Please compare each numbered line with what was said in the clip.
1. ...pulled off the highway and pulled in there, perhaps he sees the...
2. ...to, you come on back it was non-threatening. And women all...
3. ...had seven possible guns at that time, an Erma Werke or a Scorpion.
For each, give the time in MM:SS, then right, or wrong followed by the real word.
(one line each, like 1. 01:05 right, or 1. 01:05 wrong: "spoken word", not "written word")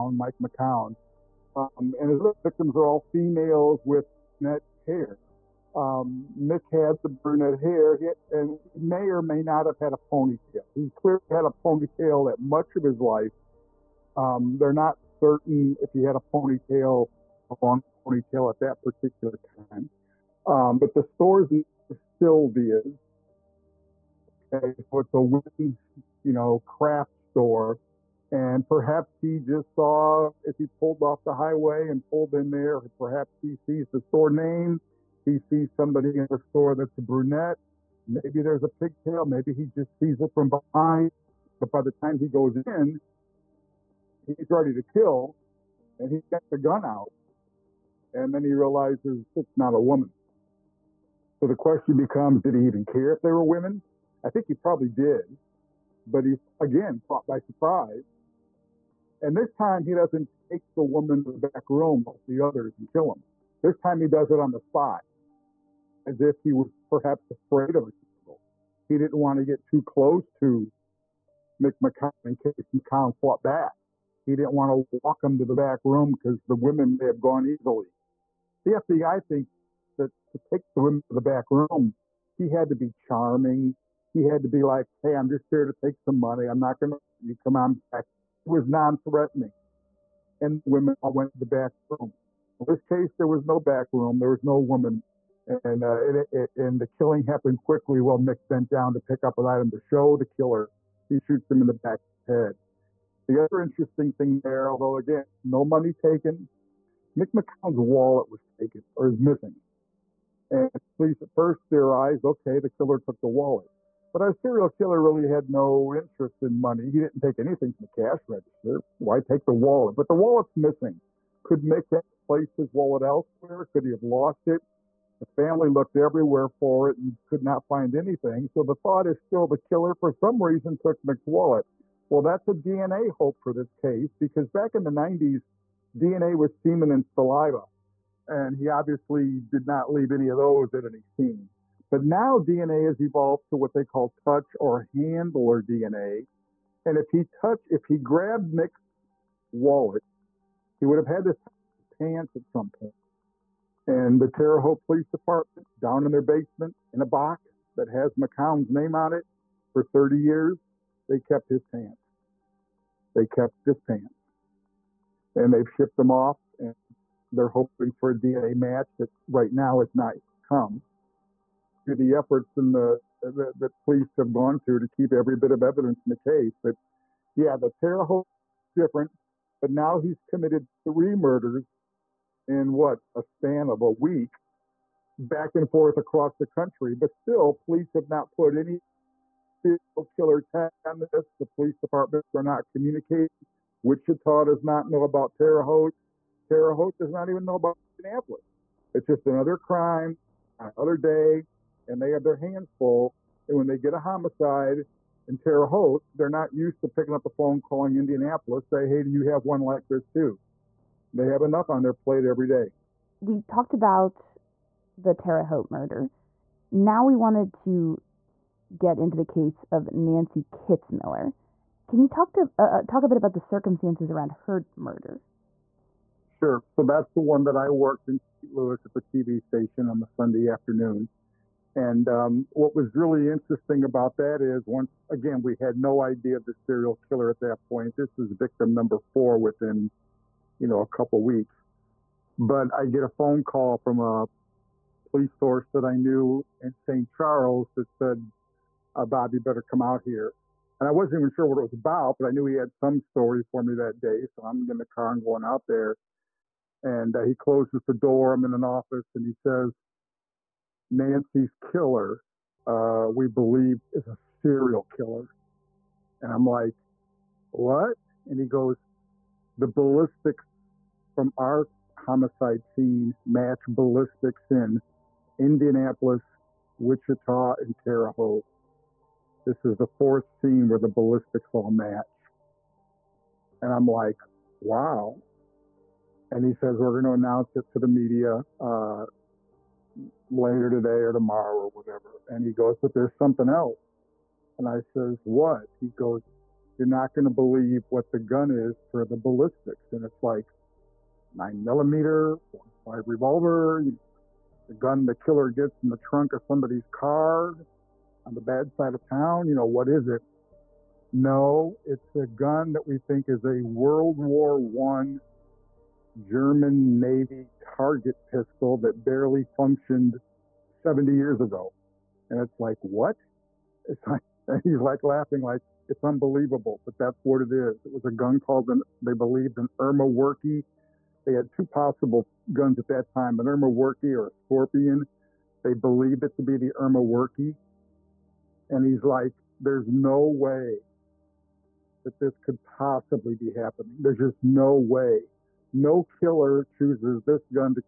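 1. 00:30 right
2. 01:26 right
3. 05:31 wrong: "two", not "seven".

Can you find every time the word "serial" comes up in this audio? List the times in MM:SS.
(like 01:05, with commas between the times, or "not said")
01:54, 03:09, 03:56, 04:24.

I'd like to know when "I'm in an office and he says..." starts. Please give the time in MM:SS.
04:18.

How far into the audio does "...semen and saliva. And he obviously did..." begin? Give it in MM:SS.
02:16.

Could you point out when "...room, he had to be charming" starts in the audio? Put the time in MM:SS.
01:21.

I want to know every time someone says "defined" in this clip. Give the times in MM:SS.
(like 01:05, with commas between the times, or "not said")
not said.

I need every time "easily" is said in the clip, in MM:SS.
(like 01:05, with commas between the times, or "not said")
01:17.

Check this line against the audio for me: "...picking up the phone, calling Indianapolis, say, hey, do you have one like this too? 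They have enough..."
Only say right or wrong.
right.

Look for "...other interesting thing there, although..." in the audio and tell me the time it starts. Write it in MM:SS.
01:43.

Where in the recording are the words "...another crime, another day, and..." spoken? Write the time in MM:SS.
03:19.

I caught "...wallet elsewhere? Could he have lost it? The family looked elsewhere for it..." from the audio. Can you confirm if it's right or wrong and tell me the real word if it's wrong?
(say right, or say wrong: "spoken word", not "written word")
wrong: "everywhere", not "elsewhere".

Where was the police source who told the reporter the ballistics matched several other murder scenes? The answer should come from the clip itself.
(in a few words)
St. Charles.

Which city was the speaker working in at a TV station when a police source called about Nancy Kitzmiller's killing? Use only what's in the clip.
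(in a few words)
St. Louis.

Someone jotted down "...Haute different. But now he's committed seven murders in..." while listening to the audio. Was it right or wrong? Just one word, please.
wrong.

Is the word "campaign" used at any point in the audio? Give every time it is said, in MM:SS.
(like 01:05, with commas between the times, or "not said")
not said.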